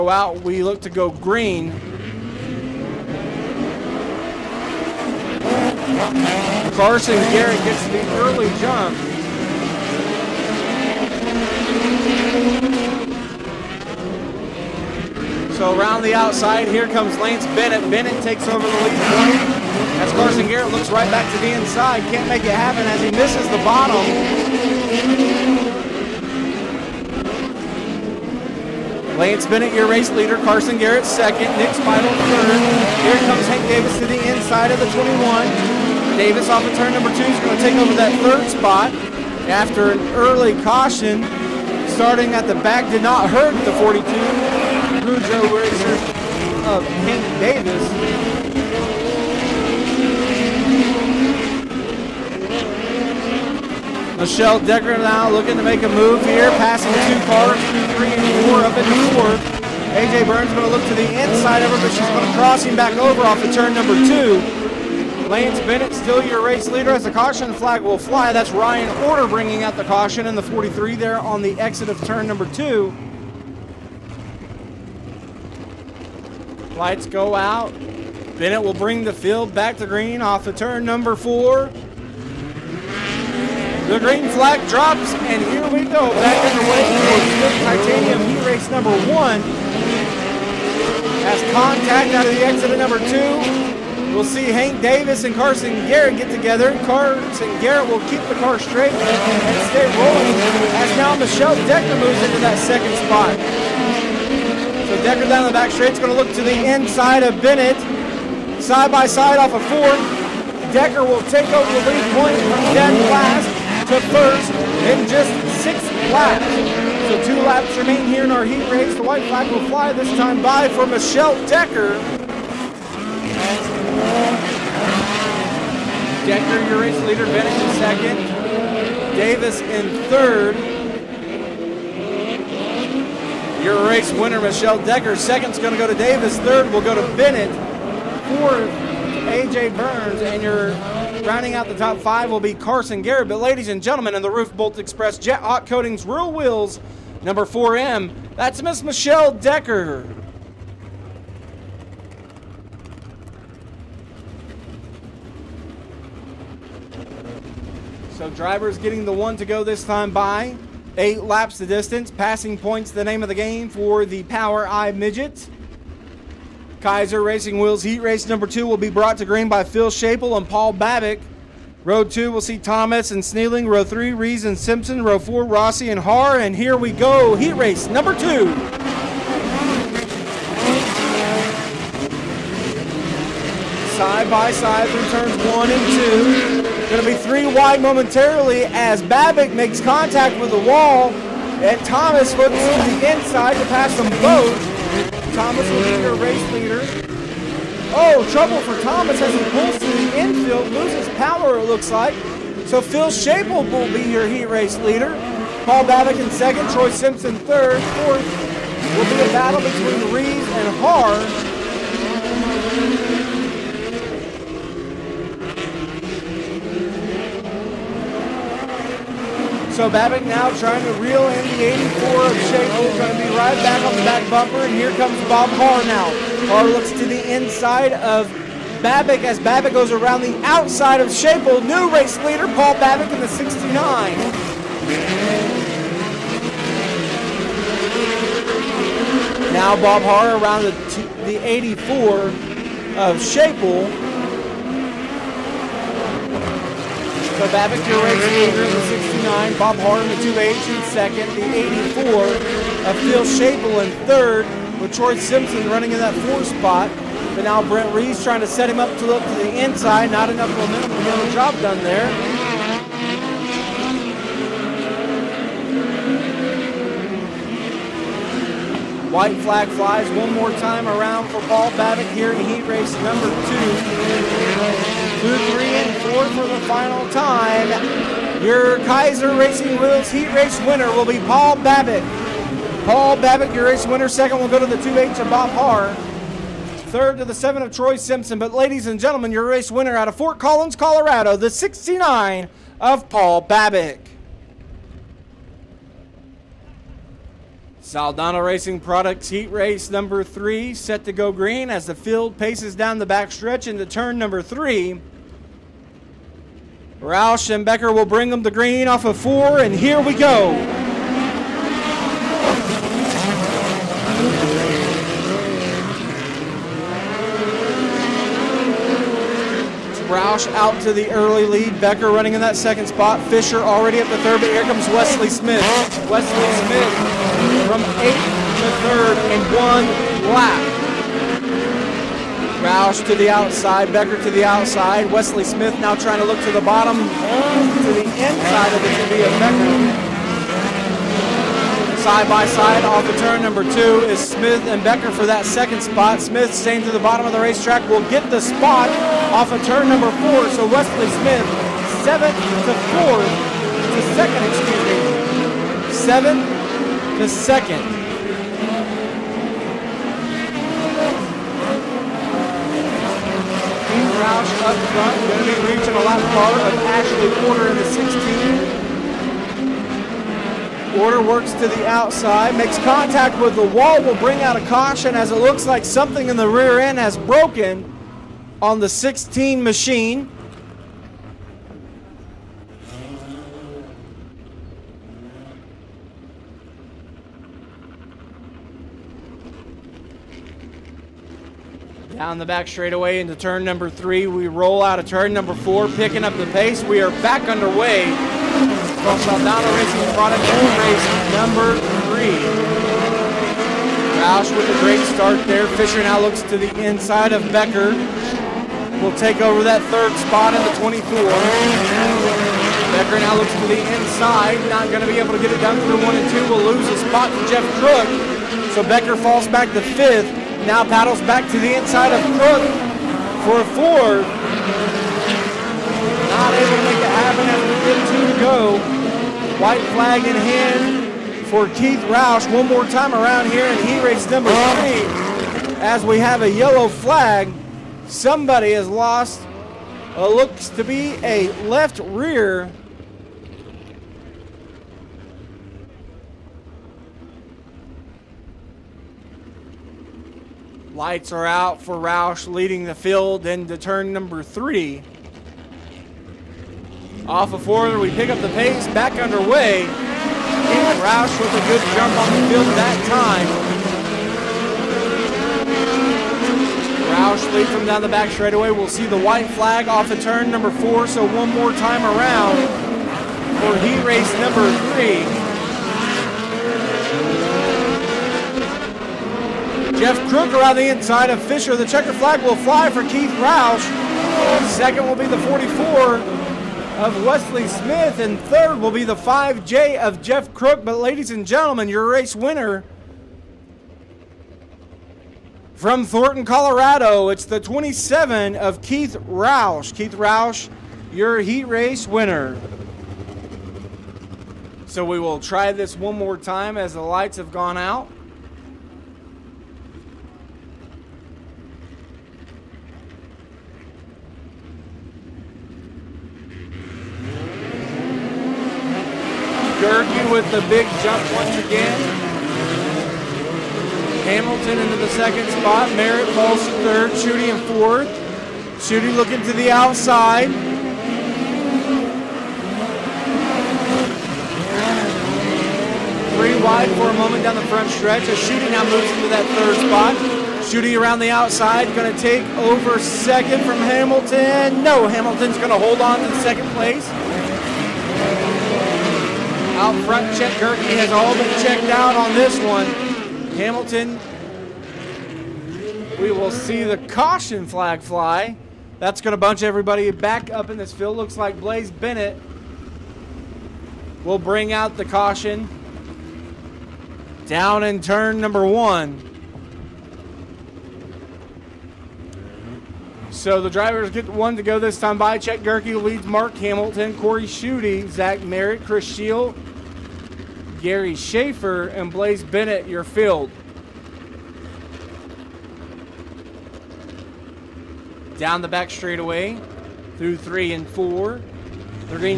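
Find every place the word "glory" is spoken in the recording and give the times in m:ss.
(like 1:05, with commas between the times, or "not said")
not said.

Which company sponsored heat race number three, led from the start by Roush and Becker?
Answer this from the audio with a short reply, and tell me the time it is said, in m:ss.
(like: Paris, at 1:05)
Saldana Racing Products, at 4:57.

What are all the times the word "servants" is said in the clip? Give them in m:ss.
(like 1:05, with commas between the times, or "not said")
not said.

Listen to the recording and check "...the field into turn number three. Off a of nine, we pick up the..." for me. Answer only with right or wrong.
wrong.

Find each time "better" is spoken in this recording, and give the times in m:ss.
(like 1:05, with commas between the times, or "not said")
not said.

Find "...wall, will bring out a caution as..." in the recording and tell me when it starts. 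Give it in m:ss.
6:13.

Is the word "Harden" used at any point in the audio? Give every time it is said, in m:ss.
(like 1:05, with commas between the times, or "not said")
4:09.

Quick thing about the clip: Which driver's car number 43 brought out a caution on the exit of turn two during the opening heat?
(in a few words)
Ryan Order.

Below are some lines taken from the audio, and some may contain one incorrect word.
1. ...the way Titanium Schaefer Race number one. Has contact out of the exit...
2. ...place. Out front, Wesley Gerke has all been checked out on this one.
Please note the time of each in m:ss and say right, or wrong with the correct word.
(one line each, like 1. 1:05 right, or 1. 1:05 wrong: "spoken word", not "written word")
1. 1:26 wrong: "Heat", not "Schaefer"
2. 9:06 wrong: "Chet", not "Wesley".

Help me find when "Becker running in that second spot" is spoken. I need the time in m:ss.
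5:21.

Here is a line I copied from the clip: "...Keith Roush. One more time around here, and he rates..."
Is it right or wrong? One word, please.
right.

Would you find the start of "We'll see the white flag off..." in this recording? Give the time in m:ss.
7:48.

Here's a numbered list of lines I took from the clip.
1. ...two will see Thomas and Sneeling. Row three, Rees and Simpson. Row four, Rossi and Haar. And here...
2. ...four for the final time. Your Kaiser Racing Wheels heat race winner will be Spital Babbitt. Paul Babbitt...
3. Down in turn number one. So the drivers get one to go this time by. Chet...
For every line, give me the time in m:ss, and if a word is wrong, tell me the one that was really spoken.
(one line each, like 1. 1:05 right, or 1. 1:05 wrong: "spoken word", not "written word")
1. 2:52 right
2. 4:36 wrong: "Paul", not "Spital"
3. 9:27 right.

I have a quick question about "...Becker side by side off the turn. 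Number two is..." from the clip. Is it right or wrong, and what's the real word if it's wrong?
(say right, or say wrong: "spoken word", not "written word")
right.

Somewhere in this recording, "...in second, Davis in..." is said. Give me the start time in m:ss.
2:07.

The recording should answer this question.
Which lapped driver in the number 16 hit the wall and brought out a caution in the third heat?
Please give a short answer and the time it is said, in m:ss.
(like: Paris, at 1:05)
Ashley Porter, at 6:06.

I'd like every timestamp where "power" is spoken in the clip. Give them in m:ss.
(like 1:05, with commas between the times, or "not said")
3:21.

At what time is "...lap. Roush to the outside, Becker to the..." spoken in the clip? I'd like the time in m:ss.
5:30.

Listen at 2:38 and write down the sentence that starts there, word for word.
So drivers getting the one to go this time by.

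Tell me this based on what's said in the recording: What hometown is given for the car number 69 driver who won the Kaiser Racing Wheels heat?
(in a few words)
Fort Collins, Colorado.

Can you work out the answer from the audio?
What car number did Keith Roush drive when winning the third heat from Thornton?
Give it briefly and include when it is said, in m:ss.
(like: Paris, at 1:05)
27, at 8:17.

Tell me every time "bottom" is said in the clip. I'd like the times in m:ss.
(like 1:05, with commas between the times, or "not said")
0:23, 5:36, 5:46.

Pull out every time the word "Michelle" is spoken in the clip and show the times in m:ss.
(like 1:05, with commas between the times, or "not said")
0:54, 1:41, 2:00, 2:14, 2:28.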